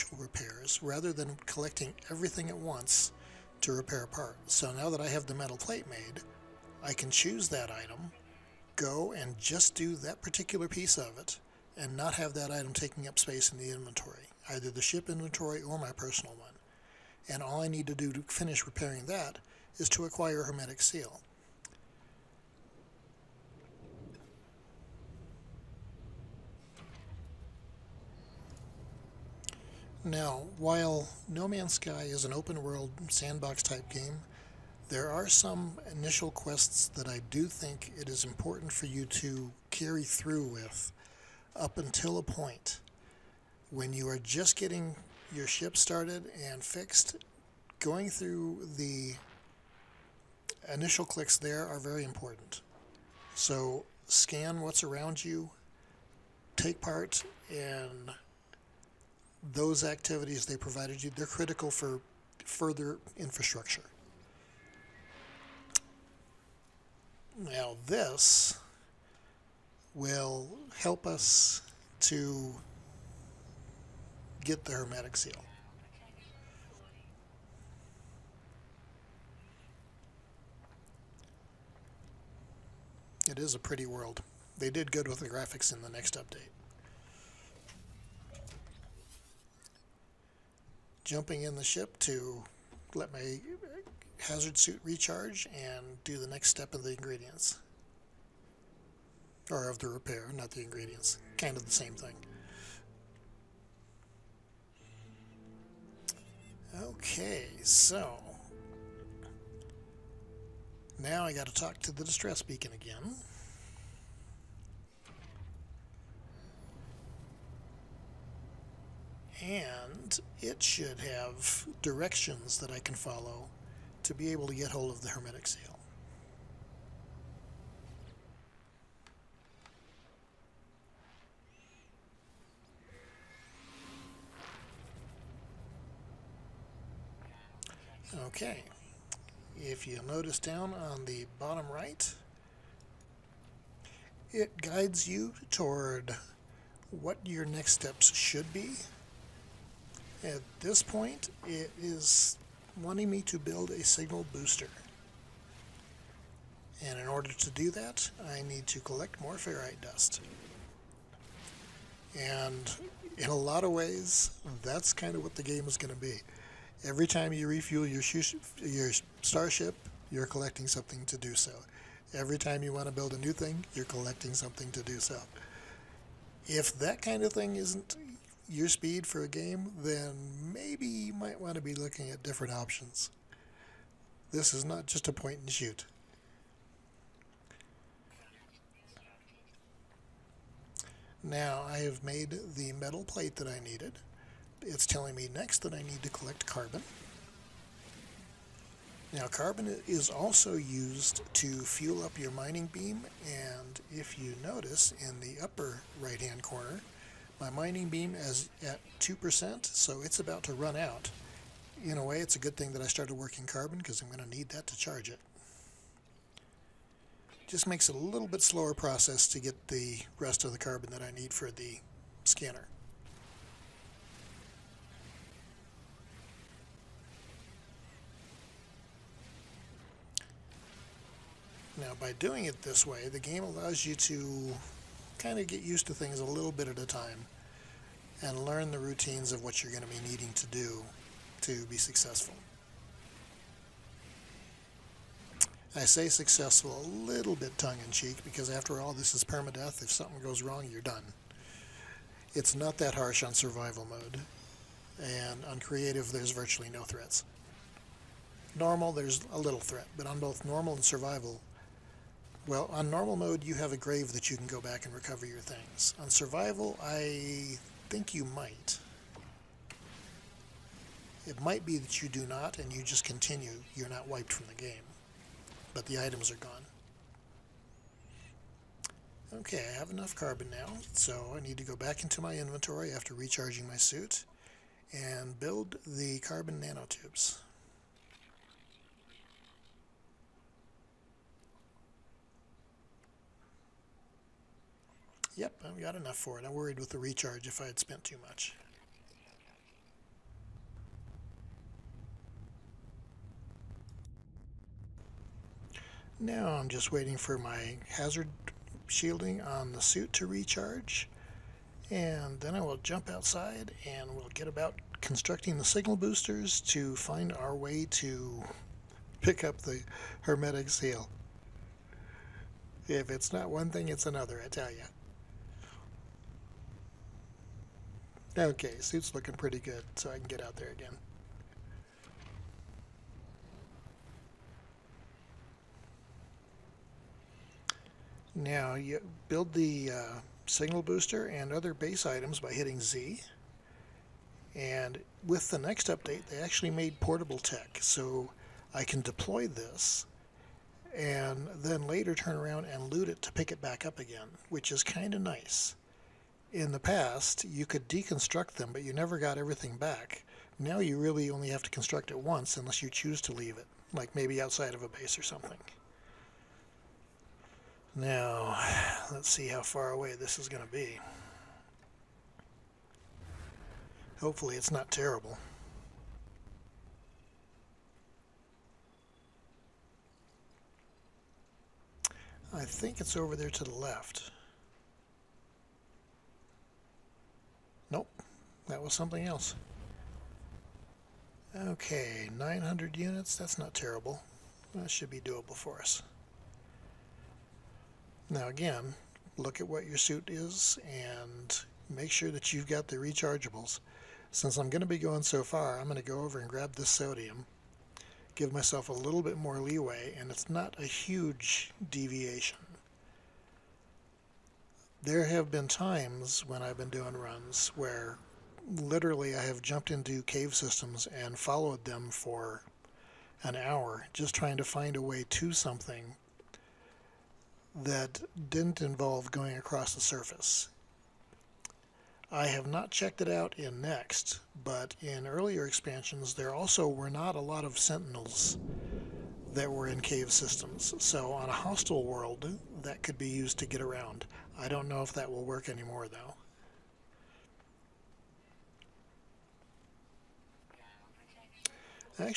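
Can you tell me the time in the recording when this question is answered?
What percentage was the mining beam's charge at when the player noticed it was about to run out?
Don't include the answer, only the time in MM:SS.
03:28.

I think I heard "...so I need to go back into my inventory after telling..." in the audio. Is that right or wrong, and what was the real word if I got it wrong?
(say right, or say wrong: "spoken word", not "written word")
wrong: "recharging", not "telling".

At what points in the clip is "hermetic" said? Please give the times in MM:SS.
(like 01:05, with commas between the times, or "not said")
00:20, 01:14, 02:05, 05:20.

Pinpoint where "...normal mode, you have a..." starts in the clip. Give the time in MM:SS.
04:22.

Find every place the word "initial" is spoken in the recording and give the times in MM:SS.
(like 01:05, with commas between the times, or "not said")
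00:35, 00:50.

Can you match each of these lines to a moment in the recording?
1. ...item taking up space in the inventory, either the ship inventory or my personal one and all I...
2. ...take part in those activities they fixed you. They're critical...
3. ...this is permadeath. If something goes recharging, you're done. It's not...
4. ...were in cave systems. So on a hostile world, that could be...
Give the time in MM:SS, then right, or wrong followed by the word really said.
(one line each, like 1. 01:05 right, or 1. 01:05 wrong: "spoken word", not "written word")
1. 00:12 right
2. 00:56 wrong: "provided", not "fixed"
3. 04:08 wrong: "wrong", not "recharging"
4. 07:19 right.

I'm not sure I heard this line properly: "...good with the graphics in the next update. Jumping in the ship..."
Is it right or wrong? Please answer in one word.
right.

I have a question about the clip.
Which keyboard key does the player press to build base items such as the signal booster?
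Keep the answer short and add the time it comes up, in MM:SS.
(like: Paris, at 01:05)
Z, at 05:42.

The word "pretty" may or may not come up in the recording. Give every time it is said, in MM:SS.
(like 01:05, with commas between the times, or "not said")
01:23, 05:29.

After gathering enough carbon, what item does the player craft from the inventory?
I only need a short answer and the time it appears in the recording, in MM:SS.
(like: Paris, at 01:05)
Carbon nanotubes, at 04:46.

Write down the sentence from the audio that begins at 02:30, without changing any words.
At this point, it is wanting me to build a signal booster.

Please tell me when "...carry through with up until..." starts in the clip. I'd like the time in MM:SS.
00:39.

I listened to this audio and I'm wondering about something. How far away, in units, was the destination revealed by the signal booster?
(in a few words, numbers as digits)
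900 units.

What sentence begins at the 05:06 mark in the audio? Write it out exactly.
Now I'm just waiting for my hazard shielding on the suit to recharge.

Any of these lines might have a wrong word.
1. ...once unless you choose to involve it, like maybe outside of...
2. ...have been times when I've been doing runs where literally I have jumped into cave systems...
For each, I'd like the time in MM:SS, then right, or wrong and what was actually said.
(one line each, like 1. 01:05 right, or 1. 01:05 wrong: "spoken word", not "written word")
1. 06:02 wrong: "leave", not "involve"
2. 06:55 right.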